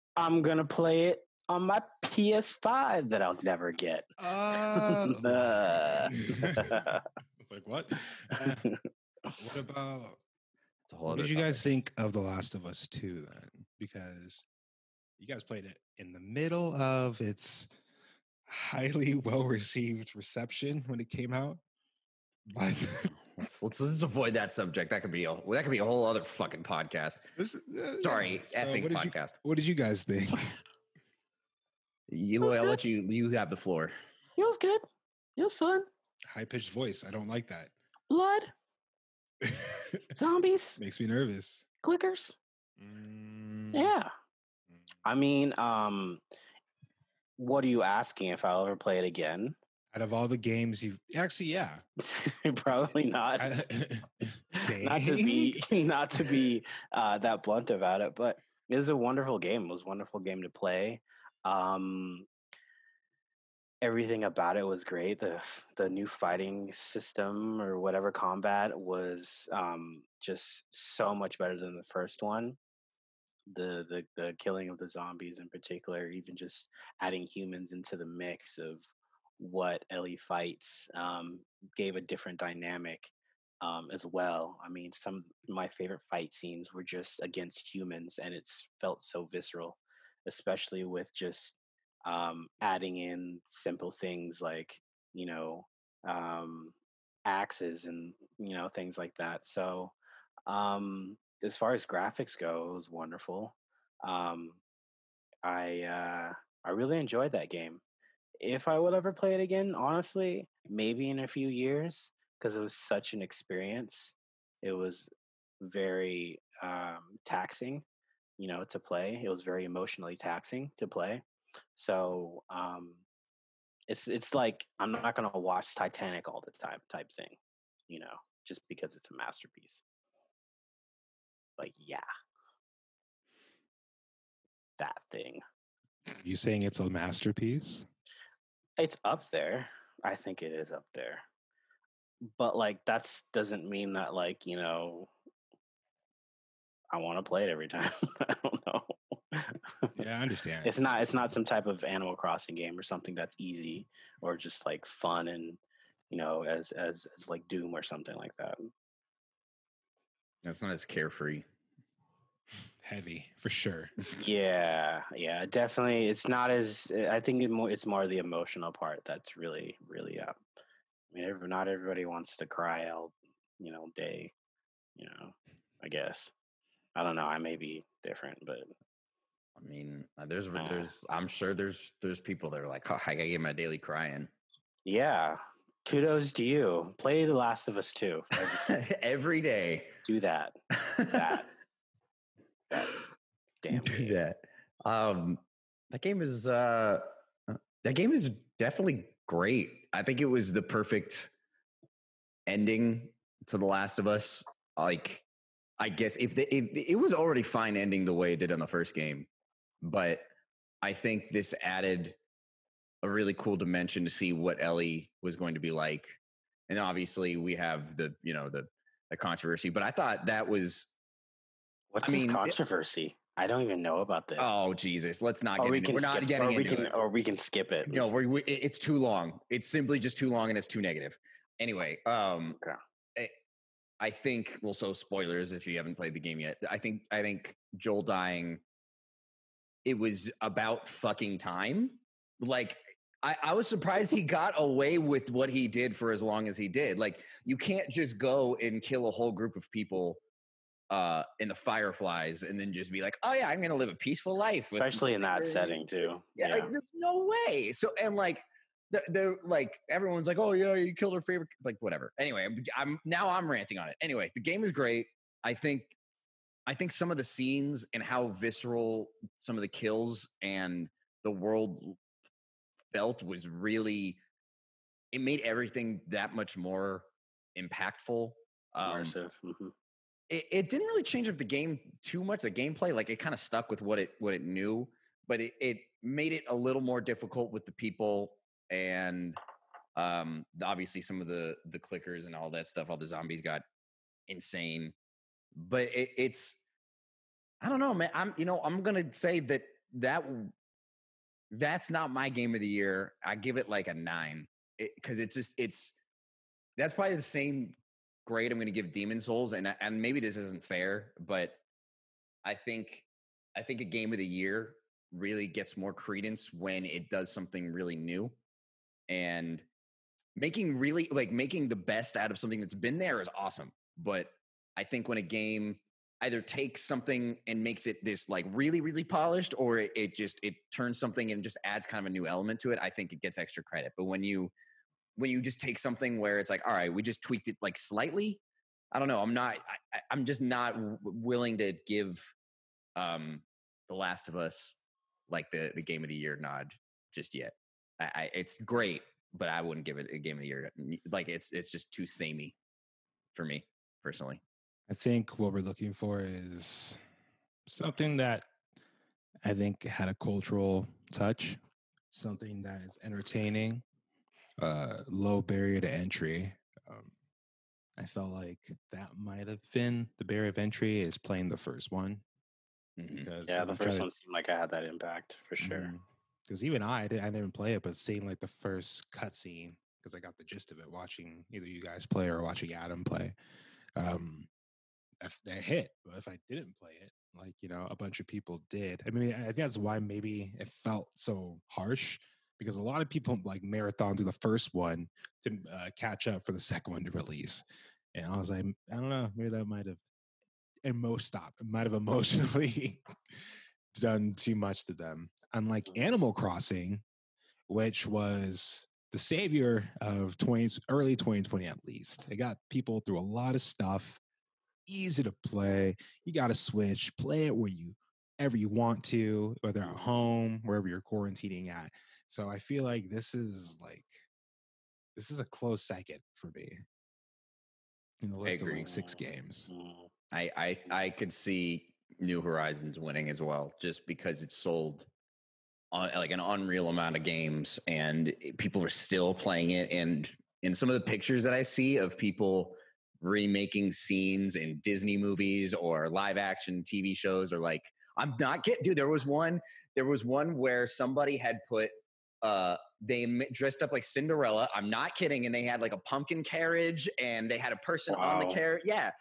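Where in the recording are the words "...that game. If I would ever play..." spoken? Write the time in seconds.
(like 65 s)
107 s.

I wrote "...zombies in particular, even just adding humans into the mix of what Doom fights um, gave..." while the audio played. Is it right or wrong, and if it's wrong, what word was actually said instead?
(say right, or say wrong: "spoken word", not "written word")
wrong: "Ellie", not "Doom".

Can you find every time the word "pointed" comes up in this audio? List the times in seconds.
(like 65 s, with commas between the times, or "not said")
not said.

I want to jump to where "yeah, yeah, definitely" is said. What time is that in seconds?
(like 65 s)
164 s.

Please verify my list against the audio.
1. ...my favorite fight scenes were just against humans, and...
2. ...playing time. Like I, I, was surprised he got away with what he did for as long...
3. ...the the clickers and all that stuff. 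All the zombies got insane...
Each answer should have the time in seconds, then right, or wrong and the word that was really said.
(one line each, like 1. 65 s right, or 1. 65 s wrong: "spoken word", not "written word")
1. 85 s right
2. 240 s wrong: "fucking", not "playing"
3. 291 s right.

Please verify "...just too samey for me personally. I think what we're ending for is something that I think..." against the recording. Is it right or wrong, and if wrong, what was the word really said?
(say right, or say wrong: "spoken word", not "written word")
wrong: "looking", not "ending".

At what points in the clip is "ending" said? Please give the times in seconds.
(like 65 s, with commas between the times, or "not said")
202 s, 207 s.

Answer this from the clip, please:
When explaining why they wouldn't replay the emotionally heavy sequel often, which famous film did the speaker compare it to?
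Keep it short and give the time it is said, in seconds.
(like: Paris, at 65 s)
Titanic, at 125 s.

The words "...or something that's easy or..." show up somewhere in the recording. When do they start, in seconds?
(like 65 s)
152 s.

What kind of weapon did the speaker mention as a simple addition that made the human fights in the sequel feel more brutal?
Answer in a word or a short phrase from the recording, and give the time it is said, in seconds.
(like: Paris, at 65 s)
axes, at 97 s.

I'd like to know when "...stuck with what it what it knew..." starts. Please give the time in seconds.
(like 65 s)
283 s.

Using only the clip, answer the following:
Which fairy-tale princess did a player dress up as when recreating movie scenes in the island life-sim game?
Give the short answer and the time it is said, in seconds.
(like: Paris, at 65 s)
Cinderella, at 454 s.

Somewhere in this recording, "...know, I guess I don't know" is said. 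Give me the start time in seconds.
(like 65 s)
175 s.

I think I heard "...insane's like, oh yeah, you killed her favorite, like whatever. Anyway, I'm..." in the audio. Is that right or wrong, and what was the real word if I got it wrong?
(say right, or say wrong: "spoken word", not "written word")
wrong: "everyone", not "insane".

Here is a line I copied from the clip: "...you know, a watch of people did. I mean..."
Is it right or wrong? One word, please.
wrong.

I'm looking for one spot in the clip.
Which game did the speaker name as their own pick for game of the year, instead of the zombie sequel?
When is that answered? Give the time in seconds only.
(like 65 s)
308 s.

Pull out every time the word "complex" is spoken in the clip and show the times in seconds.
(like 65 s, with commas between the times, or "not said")
not said.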